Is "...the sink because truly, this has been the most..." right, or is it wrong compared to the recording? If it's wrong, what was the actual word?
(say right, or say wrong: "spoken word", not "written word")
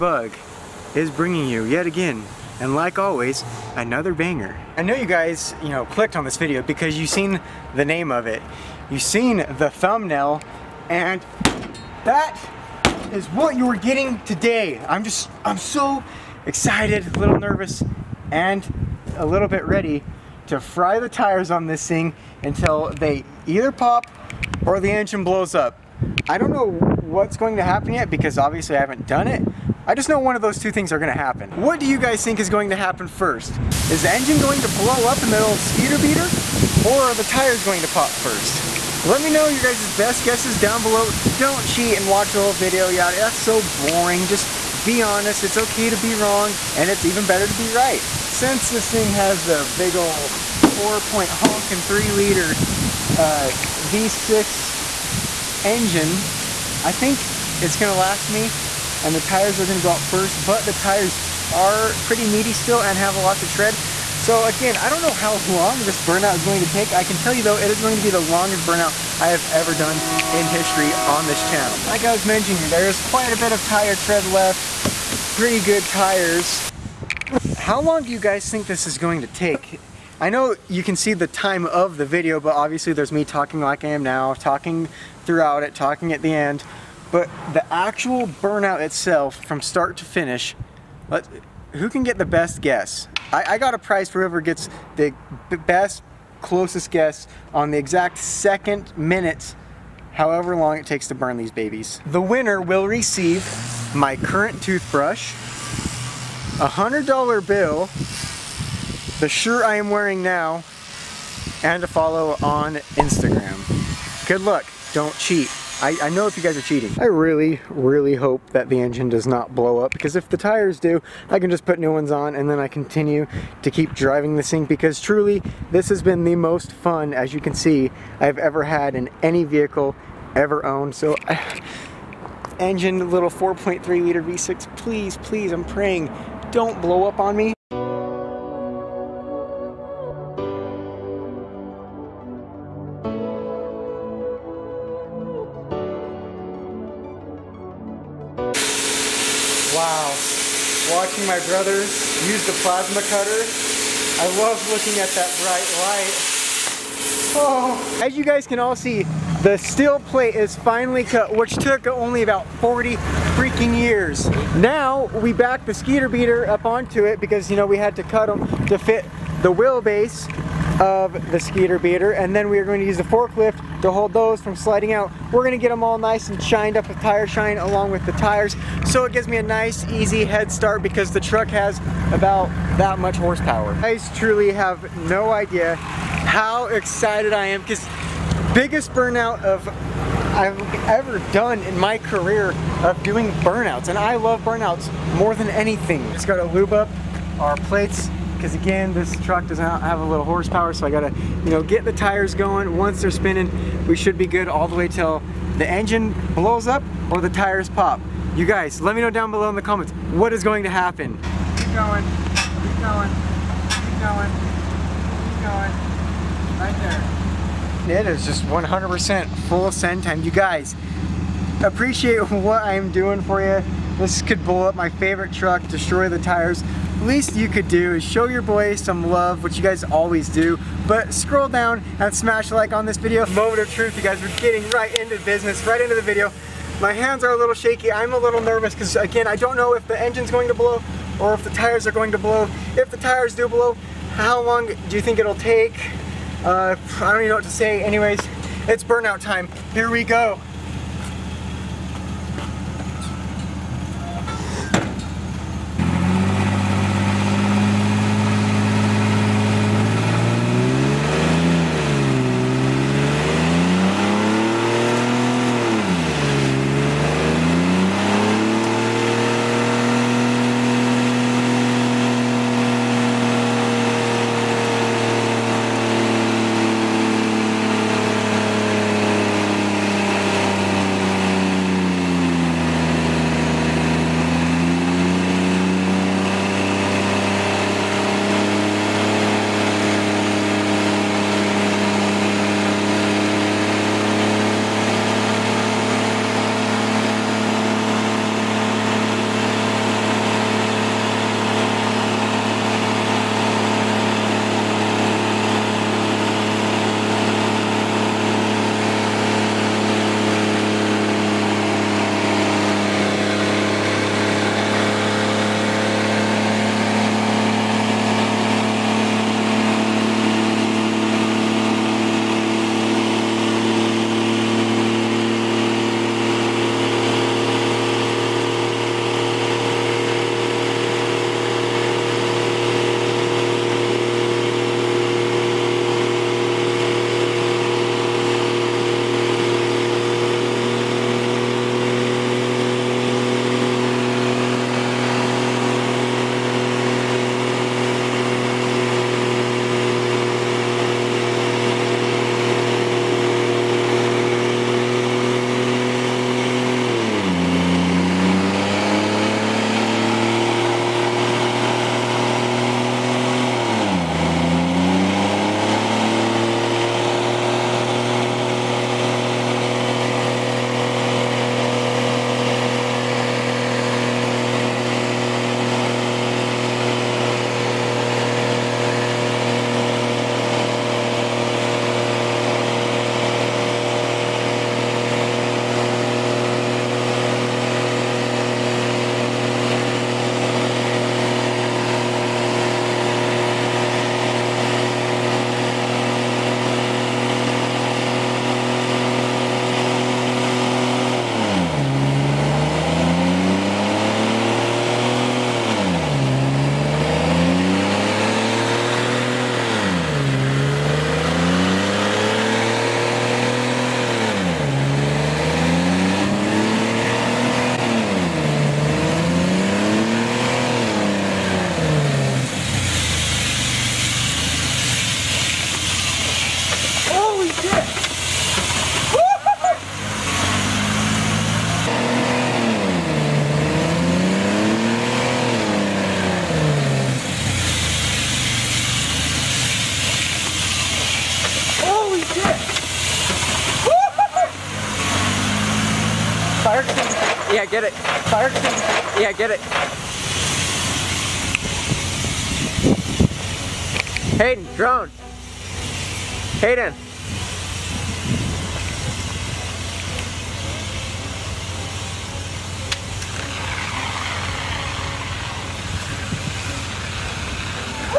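right.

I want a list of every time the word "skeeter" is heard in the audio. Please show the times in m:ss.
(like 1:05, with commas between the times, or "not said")
0:35, 2:45, 2:51.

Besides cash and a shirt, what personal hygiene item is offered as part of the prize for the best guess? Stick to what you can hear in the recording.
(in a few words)
toothbrush.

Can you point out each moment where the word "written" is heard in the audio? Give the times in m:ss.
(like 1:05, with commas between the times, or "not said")
not said.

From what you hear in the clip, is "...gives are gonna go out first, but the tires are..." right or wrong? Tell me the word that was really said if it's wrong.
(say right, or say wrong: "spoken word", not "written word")
wrong: "tires", not "gives".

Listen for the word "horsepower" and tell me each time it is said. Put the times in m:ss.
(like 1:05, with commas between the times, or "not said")
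3:03, 3:20.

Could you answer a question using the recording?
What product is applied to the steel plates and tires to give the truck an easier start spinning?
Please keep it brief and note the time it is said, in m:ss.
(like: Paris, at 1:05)
tire shine, at 2:56.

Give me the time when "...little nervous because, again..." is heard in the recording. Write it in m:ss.
3:58.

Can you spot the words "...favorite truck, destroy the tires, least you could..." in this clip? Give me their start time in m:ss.
3:44.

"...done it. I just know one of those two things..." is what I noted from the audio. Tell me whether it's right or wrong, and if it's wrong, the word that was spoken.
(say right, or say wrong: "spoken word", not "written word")
right.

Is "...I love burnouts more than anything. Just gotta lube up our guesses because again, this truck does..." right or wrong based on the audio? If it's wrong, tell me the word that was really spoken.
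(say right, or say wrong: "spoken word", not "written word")
wrong: "plates", not "guesses".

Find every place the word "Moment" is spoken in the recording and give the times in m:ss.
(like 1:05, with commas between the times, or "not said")
3:53.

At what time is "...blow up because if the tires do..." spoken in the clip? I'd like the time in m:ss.
1:59.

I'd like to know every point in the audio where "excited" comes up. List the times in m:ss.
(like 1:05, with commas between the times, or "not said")
0:16, 3:06.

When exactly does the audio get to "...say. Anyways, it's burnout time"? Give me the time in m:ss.
4:07.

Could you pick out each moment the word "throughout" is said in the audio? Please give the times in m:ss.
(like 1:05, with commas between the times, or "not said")
1:25.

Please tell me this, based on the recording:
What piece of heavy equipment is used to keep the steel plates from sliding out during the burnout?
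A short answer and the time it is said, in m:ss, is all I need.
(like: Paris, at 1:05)
forklift, at 2:53.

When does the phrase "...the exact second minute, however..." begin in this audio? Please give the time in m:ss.
1:37.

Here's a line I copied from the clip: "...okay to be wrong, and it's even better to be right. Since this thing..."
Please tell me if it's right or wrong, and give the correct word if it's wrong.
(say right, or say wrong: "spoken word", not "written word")
right.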